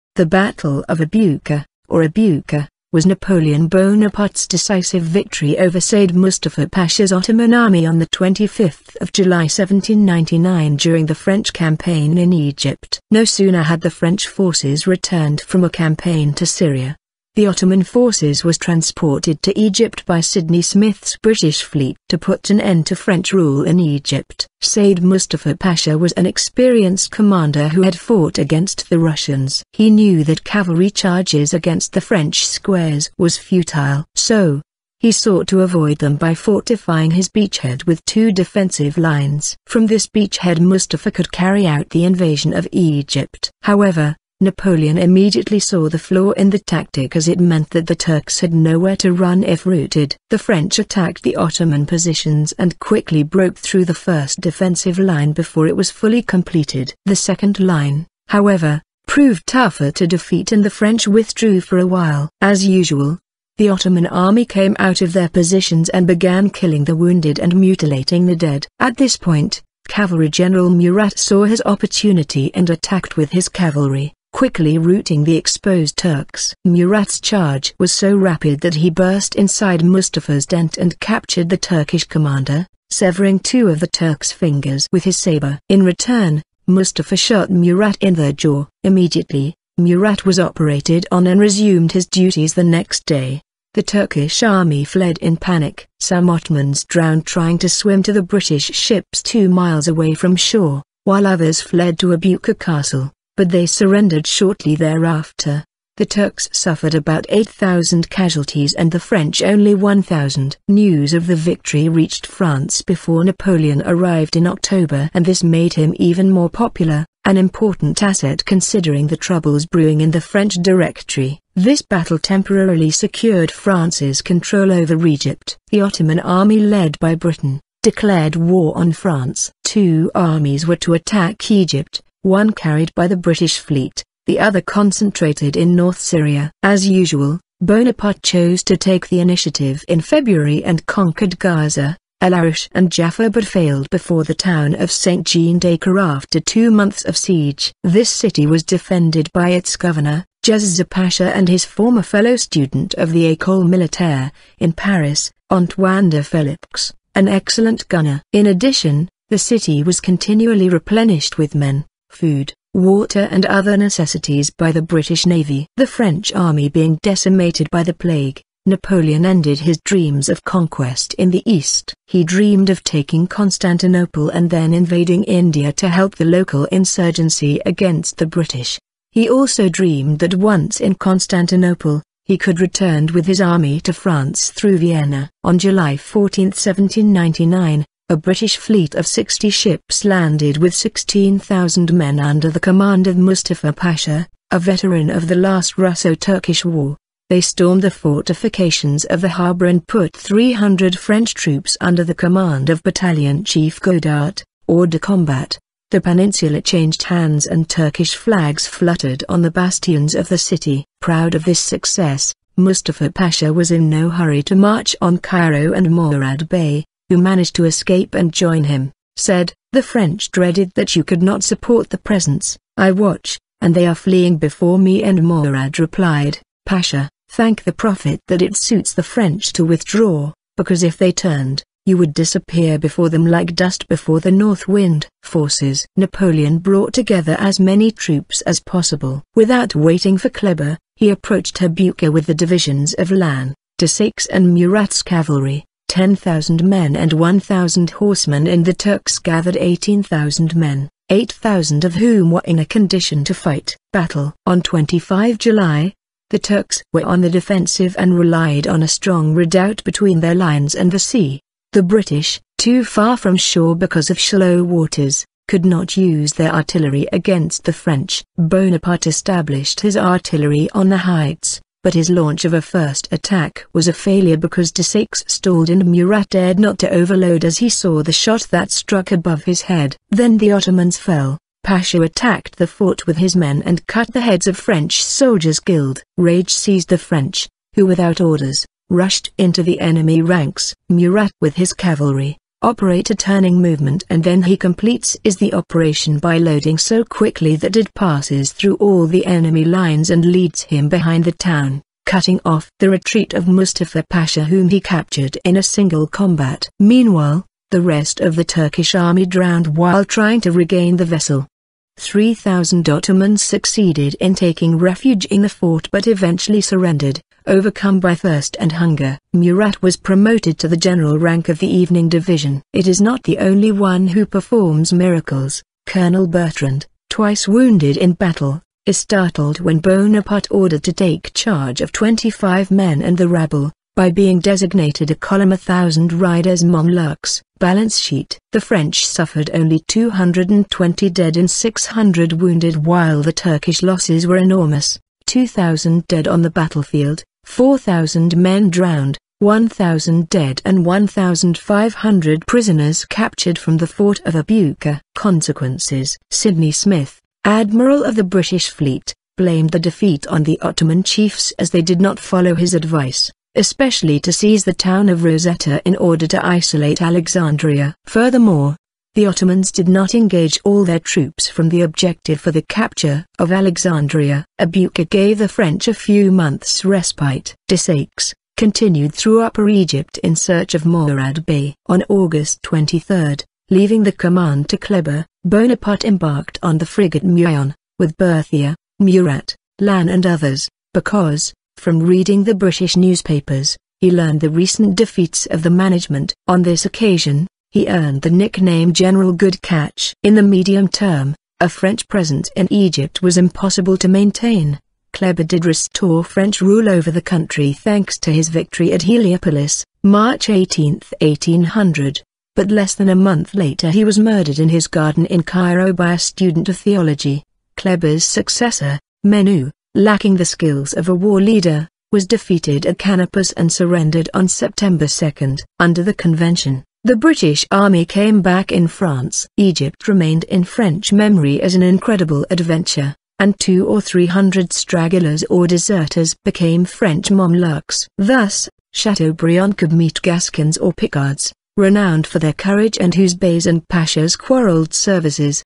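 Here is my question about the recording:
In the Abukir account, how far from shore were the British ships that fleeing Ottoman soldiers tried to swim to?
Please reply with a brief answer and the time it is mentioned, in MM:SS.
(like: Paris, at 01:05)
2 miles, at 01:39.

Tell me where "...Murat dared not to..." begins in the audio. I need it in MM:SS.
04:35.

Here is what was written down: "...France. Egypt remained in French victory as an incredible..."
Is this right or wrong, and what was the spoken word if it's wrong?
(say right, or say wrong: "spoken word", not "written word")
wrong: "memory", not "victory".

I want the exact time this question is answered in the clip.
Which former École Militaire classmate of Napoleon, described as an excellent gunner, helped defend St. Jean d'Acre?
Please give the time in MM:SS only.
02:35.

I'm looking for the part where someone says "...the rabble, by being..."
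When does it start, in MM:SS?
05:33.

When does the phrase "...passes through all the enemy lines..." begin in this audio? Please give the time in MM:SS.
04:57.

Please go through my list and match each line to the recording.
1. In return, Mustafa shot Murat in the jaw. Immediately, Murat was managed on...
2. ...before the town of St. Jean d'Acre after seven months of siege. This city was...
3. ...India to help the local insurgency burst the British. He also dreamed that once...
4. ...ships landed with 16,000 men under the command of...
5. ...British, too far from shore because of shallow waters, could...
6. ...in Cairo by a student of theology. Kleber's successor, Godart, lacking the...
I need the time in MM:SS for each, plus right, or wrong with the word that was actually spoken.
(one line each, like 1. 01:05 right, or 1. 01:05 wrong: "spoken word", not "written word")
1. 01:25 wrong: "operated", not "managed"
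2. 02:23 wrong: "two", not "seven"
3. 02:55 wrong: "against", not "burst"
4. 03:09 right
5. 04:21 right
6. 06:55 wrong: "Menou", not "Godart".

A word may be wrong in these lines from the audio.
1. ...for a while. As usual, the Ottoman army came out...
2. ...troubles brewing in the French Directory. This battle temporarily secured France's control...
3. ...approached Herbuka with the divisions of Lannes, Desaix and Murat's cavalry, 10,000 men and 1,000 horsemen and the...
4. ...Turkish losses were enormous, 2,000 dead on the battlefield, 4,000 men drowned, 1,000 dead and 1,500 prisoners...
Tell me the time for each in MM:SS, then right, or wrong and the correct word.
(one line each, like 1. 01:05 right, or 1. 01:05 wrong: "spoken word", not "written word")
1. 01:01 right
2. 01:59 right
3. 04:01 right
4. 05:43 right.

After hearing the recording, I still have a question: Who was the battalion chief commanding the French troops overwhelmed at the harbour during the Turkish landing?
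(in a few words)
Godart.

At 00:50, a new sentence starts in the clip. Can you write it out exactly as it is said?
The French attacked the Ottoman positions and quickly broke through the first defensive line before it was fully completed.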